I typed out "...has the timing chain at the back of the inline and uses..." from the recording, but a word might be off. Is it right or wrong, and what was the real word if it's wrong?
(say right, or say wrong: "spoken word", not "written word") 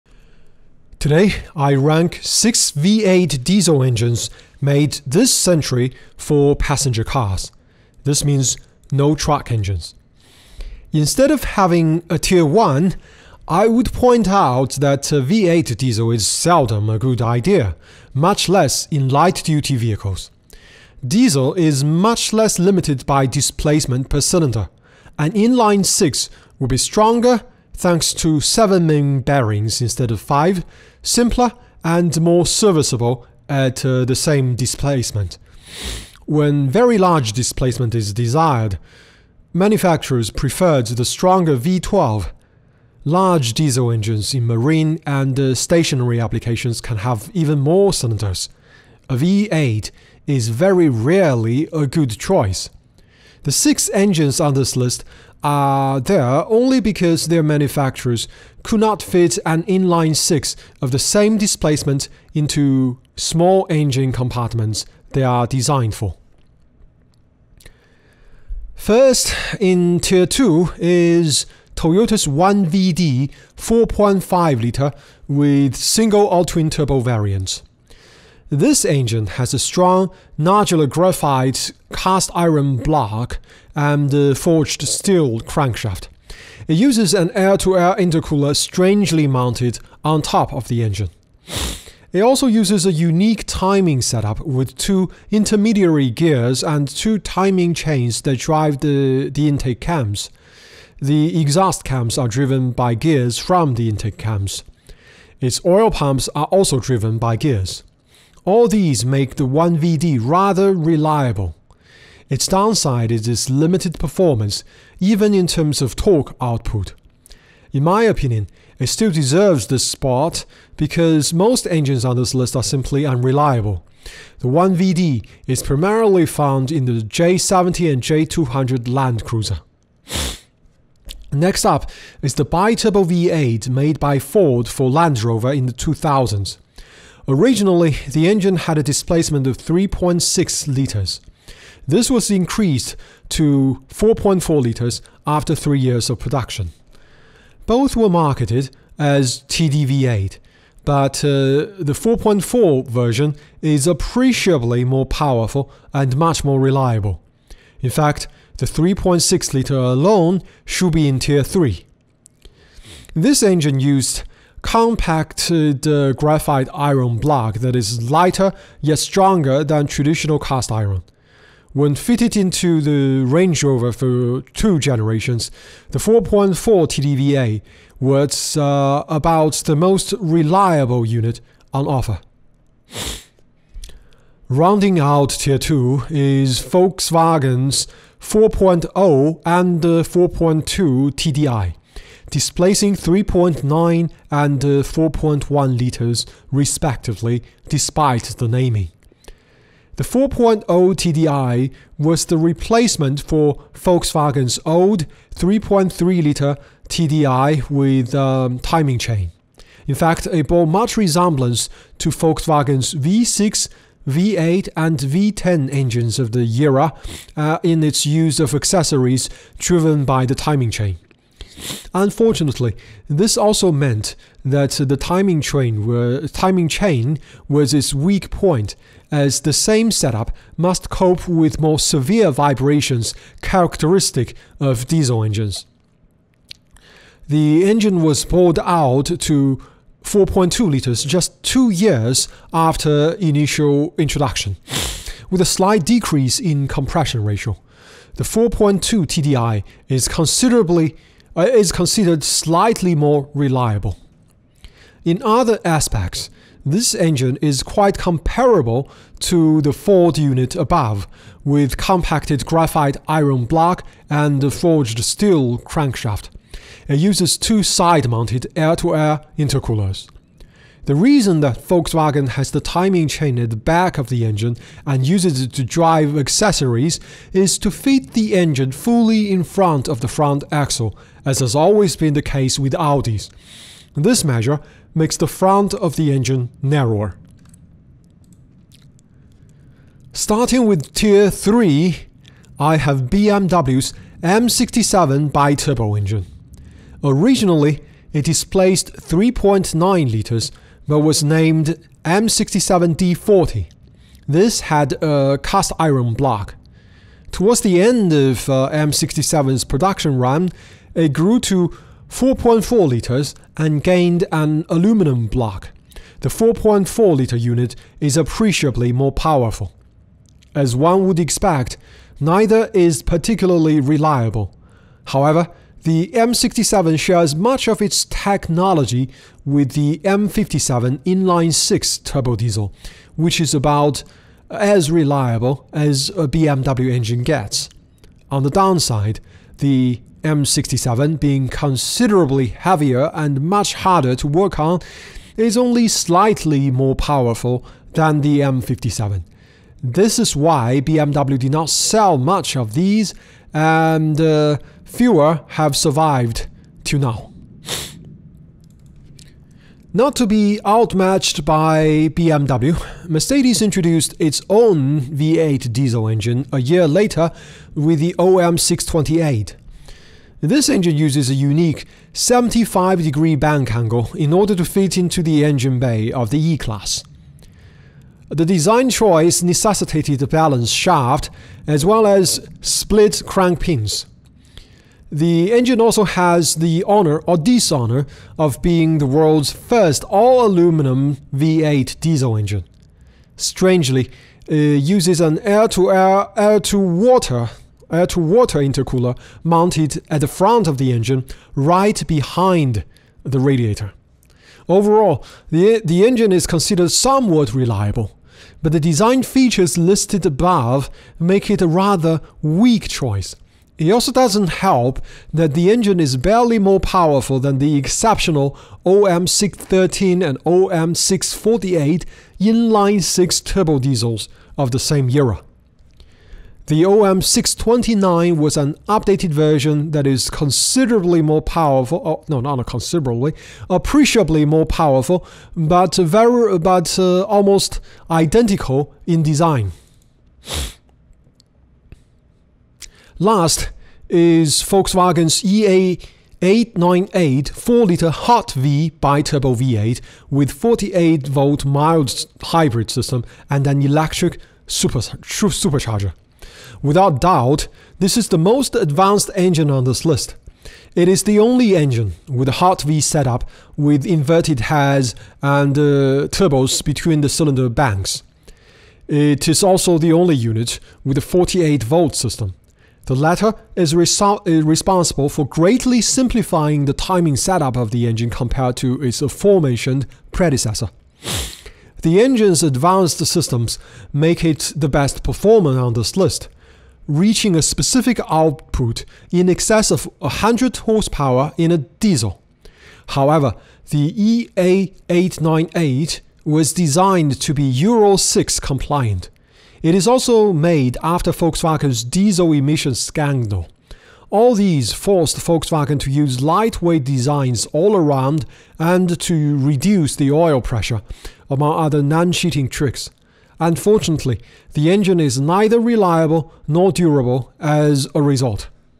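wrong: "engine", not "inline".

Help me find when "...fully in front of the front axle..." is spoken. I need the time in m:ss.
4:38.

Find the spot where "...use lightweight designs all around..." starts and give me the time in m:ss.
8:26.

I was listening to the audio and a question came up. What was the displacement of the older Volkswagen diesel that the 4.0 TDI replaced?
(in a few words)
3.3 liters.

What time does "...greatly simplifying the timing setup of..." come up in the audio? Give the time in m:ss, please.
7:55.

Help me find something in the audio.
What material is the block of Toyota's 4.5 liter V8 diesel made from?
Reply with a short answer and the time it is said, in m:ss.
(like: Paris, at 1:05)
nodular graphite cast iron, at 1:20.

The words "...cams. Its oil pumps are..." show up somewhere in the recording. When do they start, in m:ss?
1:44.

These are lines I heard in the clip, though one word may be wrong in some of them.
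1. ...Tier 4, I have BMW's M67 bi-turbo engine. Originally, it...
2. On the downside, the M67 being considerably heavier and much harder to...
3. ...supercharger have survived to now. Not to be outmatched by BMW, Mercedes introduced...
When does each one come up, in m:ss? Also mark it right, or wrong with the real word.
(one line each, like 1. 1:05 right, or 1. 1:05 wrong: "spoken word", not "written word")
1. 4:50 wrong: "3", not "4"
2. 5:38 right
3. 5:54 wrong: "fewer", not "supercharger".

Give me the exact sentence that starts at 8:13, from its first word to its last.
However, the EA898 was designed to be Euro 6 compliant, it is also made after Volkswagen's diesel emissions scandal.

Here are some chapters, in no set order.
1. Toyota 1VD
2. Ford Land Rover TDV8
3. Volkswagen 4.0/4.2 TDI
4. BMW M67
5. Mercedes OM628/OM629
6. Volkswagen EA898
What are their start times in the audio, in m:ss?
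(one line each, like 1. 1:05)
1. 1:10
2. 2:12
3. 3:06
4. 4:51
5. 5:58
6. 7:21.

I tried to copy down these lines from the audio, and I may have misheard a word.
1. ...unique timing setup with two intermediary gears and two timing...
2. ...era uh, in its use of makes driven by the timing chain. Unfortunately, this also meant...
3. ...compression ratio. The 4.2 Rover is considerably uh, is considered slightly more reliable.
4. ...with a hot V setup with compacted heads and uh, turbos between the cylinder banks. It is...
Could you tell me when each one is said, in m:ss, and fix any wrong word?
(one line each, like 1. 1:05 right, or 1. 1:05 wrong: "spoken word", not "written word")
1. 1:32 right
2. 3:36 wrong: "accessories", not "makes"
3. 4:06 wrong: "TDI", not "Rover"
4. 7:42 wrong: "inverted", not "compacted".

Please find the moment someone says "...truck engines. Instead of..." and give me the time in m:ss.
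0:09.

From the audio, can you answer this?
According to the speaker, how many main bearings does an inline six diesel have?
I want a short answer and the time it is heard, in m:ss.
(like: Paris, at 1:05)
7, at 0:28.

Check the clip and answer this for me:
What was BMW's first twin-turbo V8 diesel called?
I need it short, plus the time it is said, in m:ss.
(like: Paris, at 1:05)
M67D40, at 5:02.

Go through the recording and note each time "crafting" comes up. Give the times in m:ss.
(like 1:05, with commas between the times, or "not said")
not said.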